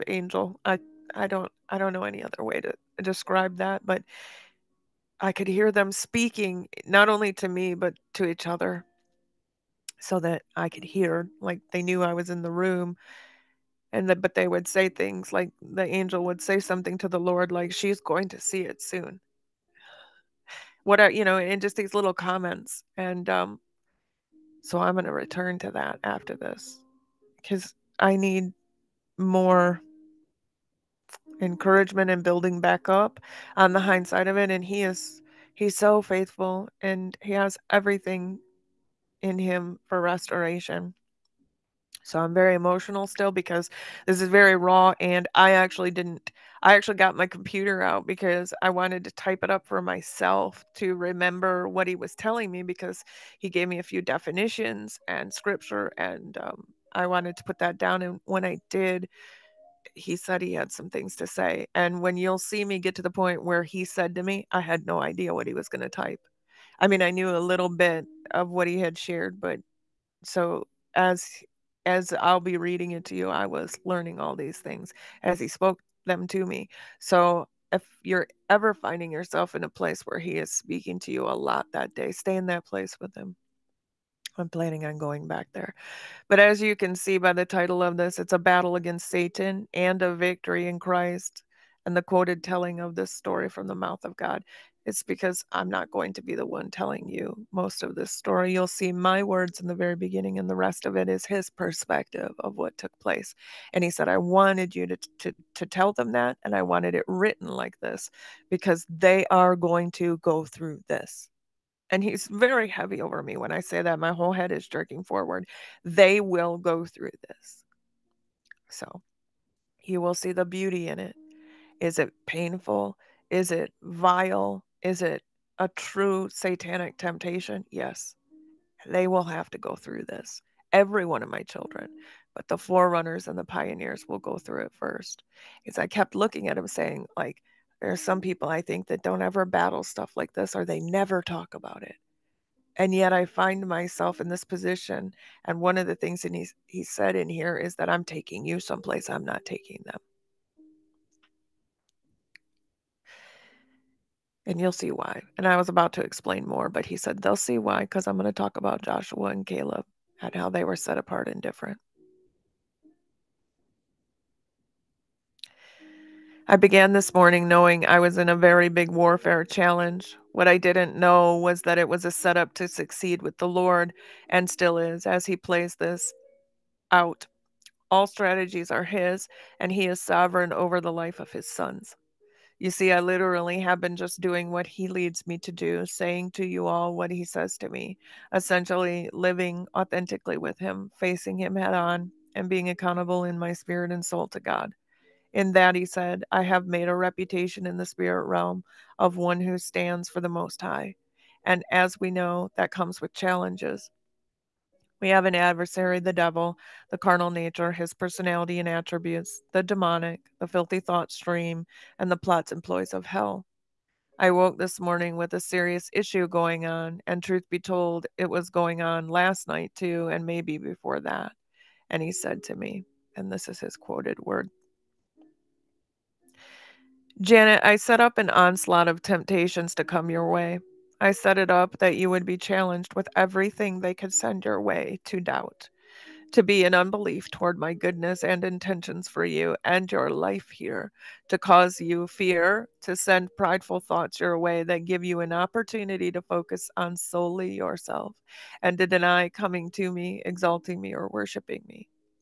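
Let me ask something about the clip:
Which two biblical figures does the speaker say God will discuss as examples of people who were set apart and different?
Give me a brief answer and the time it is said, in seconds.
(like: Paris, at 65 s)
Joshua and Caleb, at 158 s.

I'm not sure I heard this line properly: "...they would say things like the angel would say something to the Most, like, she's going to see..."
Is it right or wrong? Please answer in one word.
wrong.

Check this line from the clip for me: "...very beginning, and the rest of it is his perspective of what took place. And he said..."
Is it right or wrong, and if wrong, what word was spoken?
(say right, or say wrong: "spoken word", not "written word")
right.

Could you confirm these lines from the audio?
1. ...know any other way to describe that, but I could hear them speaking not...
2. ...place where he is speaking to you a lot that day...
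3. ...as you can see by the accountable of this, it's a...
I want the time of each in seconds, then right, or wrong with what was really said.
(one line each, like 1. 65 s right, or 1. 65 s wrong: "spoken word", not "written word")
1. 1 s right
2. 79 s right
3. 86 s wrong: "title", not "accountable".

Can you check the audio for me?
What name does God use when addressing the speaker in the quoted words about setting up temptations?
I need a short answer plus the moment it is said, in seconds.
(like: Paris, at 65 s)
Janet, at 227 s.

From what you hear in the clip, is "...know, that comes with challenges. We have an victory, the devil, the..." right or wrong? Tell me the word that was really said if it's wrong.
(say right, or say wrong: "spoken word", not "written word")
wrong: "adversary", not "victory".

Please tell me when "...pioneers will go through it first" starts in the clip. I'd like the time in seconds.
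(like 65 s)
133 s.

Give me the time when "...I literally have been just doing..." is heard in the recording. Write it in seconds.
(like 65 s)
182 s.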